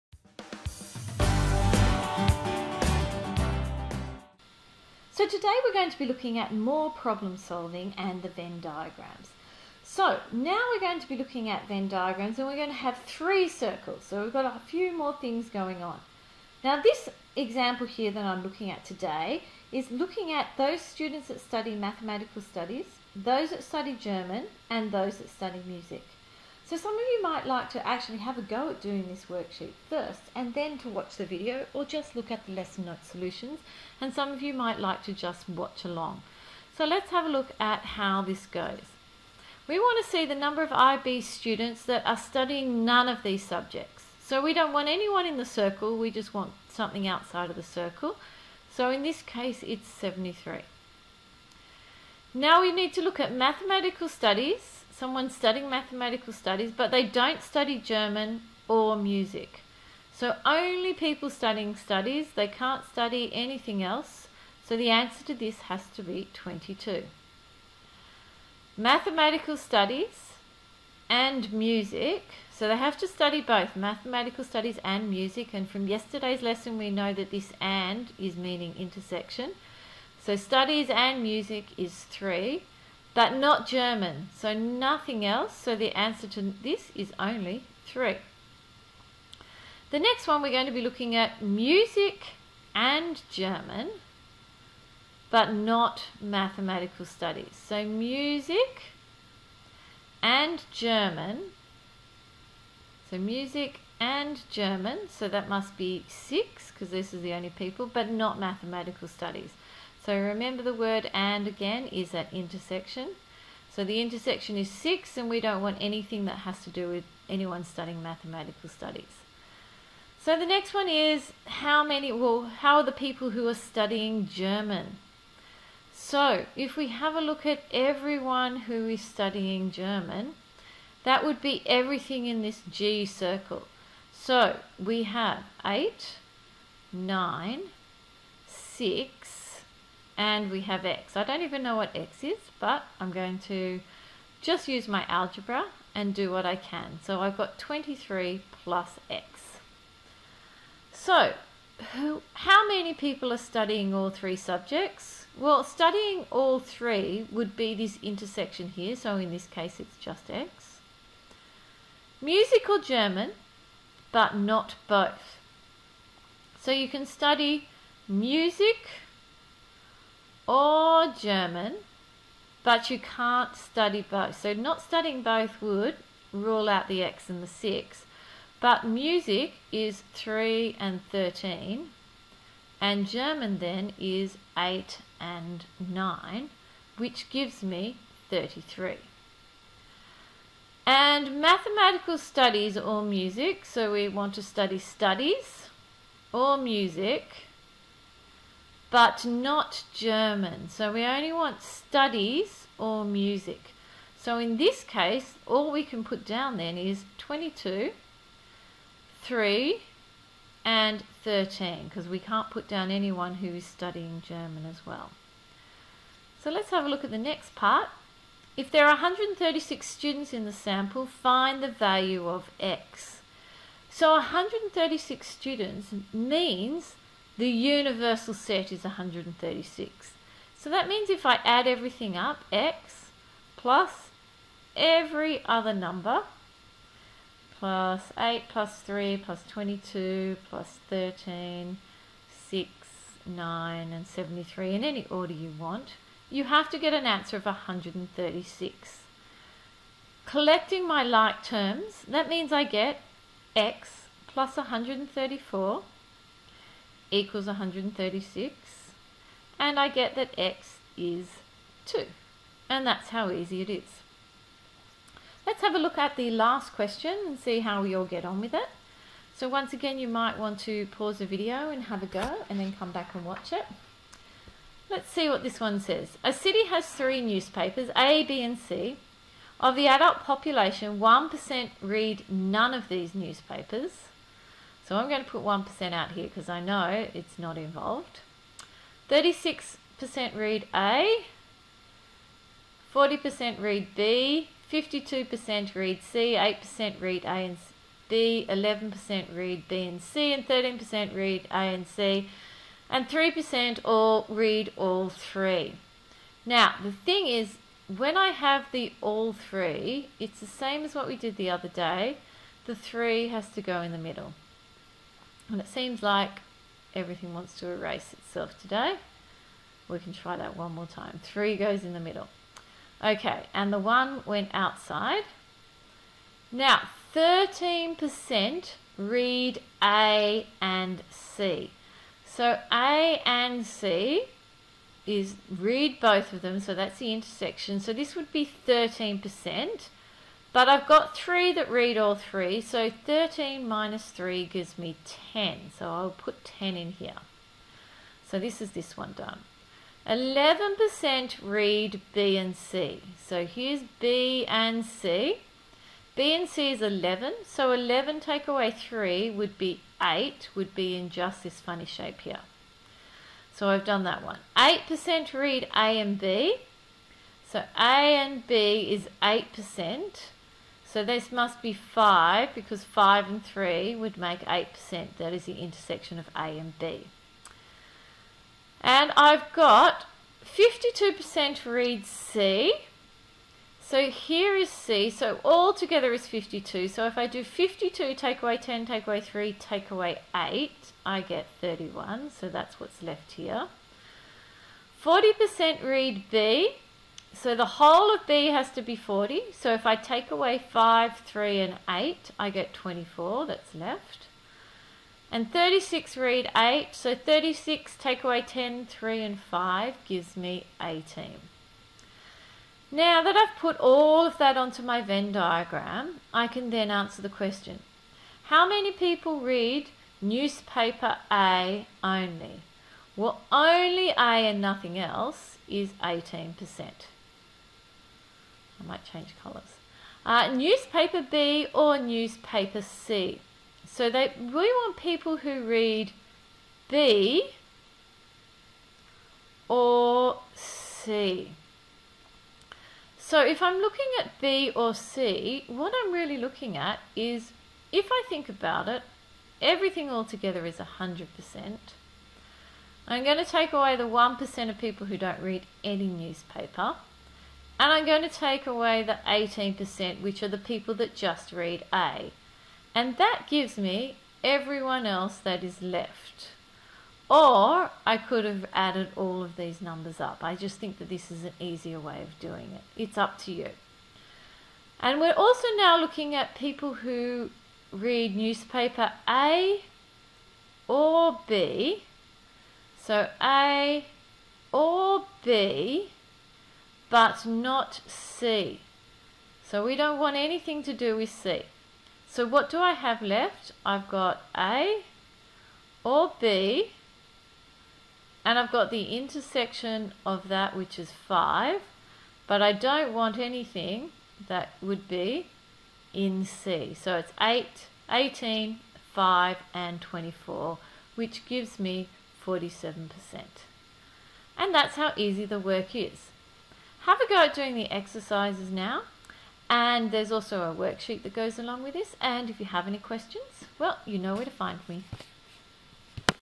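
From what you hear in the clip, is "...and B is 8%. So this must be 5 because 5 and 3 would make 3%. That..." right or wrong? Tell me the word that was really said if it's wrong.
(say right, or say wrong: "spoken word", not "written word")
wrong: "8", not "3".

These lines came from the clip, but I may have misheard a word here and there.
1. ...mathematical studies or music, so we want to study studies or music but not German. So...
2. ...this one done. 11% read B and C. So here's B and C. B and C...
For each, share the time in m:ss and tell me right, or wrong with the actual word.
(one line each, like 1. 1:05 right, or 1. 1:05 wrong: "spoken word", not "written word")
1. 3:11 right
2. 5:48 right.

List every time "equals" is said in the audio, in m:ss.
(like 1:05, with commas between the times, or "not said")
4:17.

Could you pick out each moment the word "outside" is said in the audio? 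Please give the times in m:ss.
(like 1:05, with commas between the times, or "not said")
0:47, 5:24.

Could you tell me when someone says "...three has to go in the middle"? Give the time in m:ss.
5:12.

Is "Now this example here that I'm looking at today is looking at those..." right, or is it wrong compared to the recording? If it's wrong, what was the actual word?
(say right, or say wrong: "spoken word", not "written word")
right.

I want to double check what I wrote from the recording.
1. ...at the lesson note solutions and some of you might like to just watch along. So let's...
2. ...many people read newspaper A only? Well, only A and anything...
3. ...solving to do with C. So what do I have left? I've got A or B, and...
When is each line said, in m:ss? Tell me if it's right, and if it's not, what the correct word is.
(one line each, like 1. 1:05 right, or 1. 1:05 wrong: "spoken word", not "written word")
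1. 0:32 right
2. 6:58 wrong: "nothing", not "anything"
3. 8:10 wrong: "anything", not "solving".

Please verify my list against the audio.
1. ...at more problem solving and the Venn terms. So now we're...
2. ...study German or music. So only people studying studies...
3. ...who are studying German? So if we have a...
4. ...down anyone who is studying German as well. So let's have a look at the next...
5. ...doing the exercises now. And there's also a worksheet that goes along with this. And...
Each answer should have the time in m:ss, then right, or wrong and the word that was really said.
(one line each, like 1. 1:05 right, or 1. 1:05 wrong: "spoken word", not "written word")
1. 0:06 wrong: "diagrams", not "terms"
2. 0:57 right
3. 2:03 right
4. 3:32 right
5. 8:37 right.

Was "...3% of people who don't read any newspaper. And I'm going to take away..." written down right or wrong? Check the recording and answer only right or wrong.
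wrong.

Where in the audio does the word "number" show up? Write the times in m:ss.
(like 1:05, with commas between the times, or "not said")
0:40, 3:55, 7:49.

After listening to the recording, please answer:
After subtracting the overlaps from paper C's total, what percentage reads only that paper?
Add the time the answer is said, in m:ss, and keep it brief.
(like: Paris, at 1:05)
31, at 6:31.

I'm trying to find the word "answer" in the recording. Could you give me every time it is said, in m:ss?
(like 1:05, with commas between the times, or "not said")
1:04, 1:25, 4:07, 6:56.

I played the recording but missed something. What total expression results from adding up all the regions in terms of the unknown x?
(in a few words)
x + 134.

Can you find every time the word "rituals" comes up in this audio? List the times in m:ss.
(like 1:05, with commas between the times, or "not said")
not said.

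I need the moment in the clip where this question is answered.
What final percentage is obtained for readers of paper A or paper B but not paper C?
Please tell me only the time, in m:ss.
8:32.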